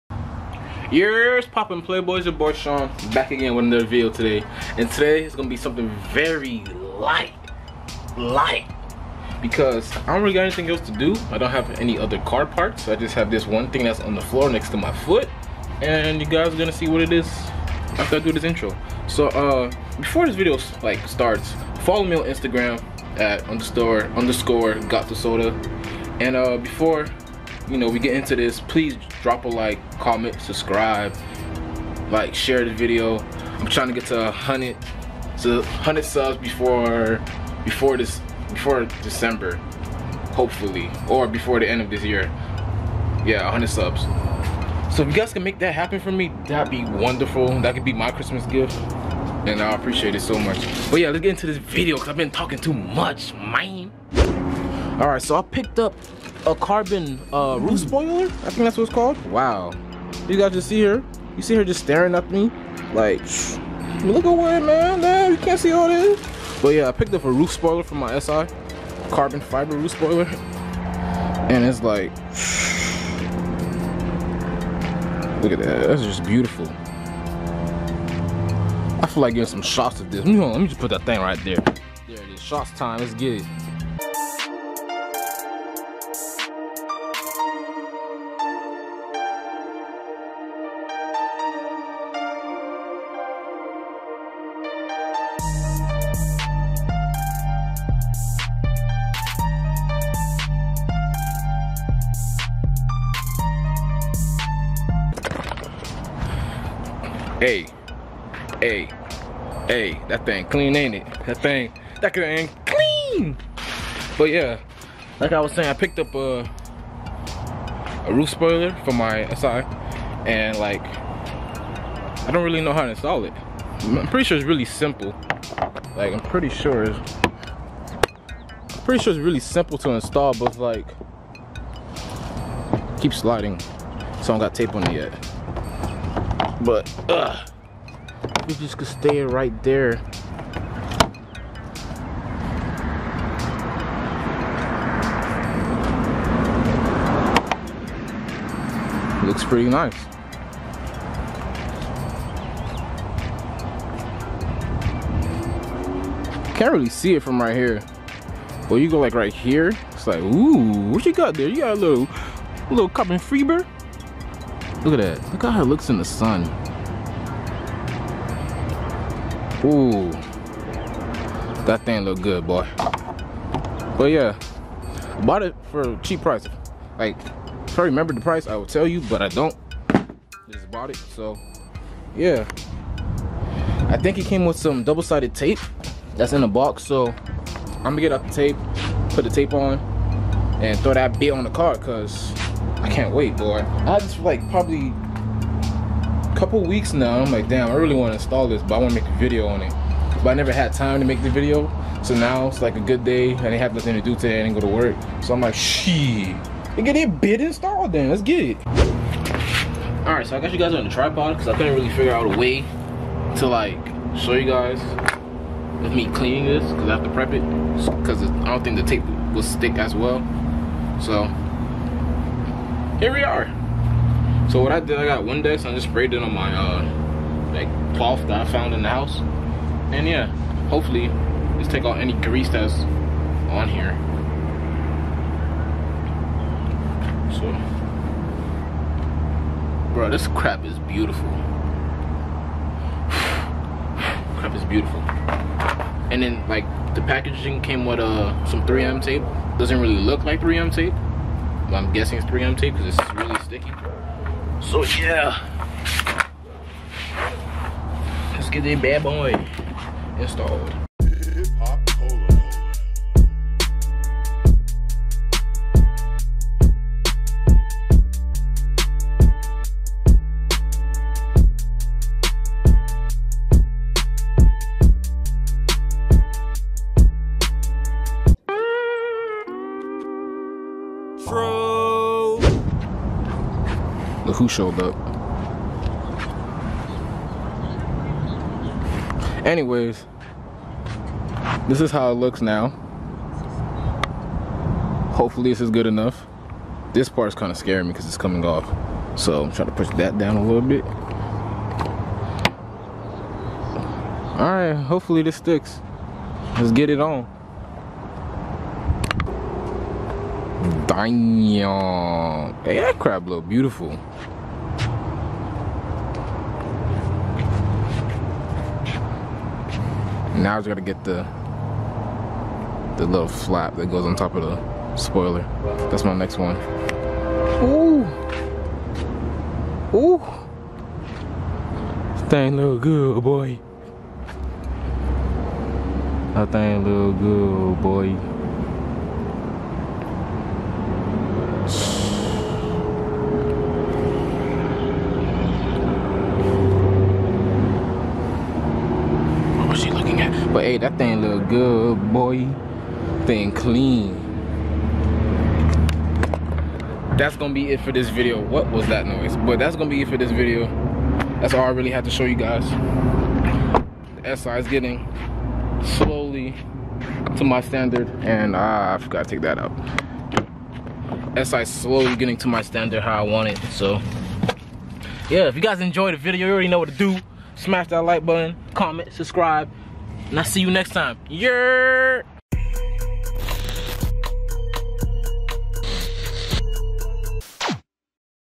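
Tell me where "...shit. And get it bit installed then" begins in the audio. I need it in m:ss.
3:25.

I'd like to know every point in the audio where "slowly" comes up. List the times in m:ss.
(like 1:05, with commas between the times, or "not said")
6:05, 6:11.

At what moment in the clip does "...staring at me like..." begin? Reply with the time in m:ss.
1:01.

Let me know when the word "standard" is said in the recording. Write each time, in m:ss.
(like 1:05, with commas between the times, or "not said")
6:07, 6:12.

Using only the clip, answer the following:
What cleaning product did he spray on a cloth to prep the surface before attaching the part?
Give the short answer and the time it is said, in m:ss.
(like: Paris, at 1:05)
Windex, at 3:45.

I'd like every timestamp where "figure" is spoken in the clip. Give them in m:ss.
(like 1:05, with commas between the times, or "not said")
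3:31.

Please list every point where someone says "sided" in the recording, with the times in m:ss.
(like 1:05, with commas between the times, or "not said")
3:04.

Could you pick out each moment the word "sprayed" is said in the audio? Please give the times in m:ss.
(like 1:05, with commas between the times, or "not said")
3:45.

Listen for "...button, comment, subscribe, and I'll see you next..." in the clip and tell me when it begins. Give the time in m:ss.
6:18.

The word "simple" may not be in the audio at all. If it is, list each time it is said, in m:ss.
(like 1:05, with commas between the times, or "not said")
2:04, 2:09.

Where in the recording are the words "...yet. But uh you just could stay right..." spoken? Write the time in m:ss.
2:14.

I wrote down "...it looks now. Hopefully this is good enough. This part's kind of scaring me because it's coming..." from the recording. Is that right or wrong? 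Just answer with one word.
right.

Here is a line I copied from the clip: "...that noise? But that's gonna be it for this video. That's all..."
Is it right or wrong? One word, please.
right.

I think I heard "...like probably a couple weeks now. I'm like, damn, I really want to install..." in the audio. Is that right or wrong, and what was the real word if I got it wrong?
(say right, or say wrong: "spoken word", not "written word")
right.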